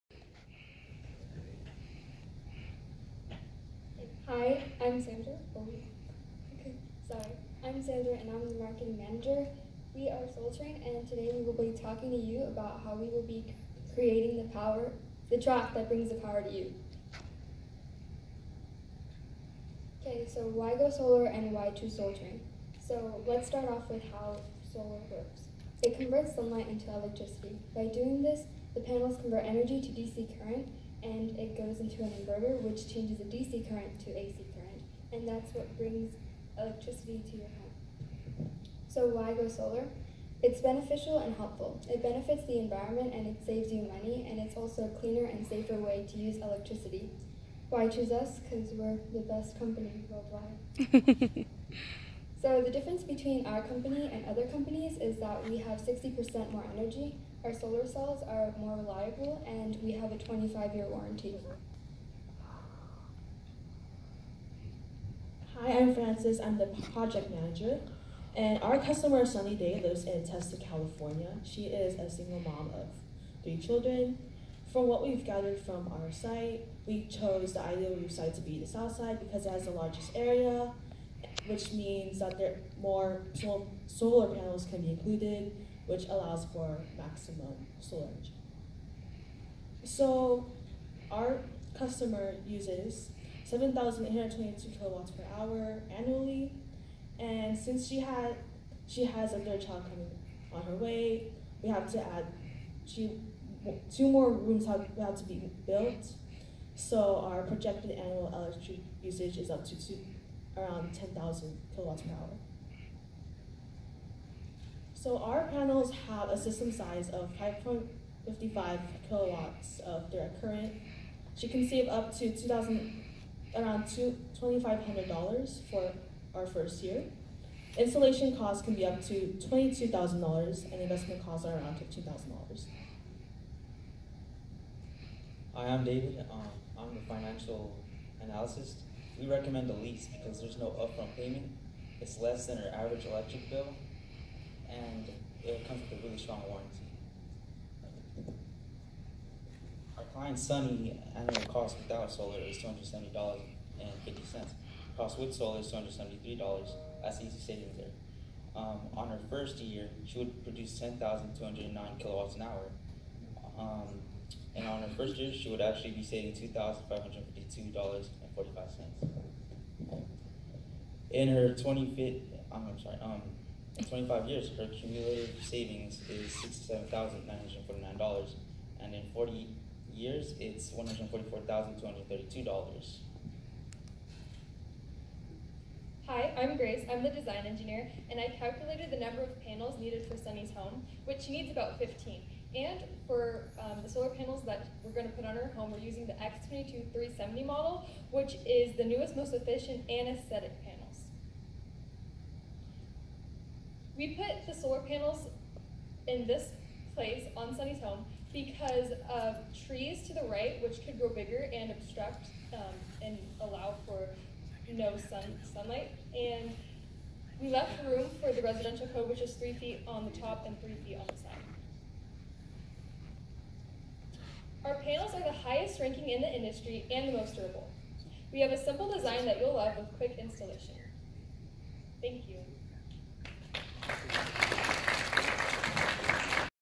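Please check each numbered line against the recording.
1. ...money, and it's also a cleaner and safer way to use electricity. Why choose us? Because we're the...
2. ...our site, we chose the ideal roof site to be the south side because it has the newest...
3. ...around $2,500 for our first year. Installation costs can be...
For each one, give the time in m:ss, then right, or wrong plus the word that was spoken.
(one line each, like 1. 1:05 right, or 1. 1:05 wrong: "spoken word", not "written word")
1. 0:43 right
2. 1:16 wrong: "largest", not "newest"
3. 2:03 right.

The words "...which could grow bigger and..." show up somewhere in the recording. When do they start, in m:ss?
3:30.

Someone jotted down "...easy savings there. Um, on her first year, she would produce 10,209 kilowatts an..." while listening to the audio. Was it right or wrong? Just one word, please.
right.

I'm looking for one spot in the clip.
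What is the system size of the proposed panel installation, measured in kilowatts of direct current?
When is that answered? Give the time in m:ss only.
1:57.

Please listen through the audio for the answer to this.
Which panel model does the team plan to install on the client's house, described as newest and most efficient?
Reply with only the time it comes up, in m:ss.
3:16.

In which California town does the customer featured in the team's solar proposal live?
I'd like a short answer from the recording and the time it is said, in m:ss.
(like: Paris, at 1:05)
Testa, at 1:10.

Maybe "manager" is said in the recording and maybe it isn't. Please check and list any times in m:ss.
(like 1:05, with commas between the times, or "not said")
0:08, 1:07.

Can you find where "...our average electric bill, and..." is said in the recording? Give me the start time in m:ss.
2:22.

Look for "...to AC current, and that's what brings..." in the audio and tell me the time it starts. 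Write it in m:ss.
0:34.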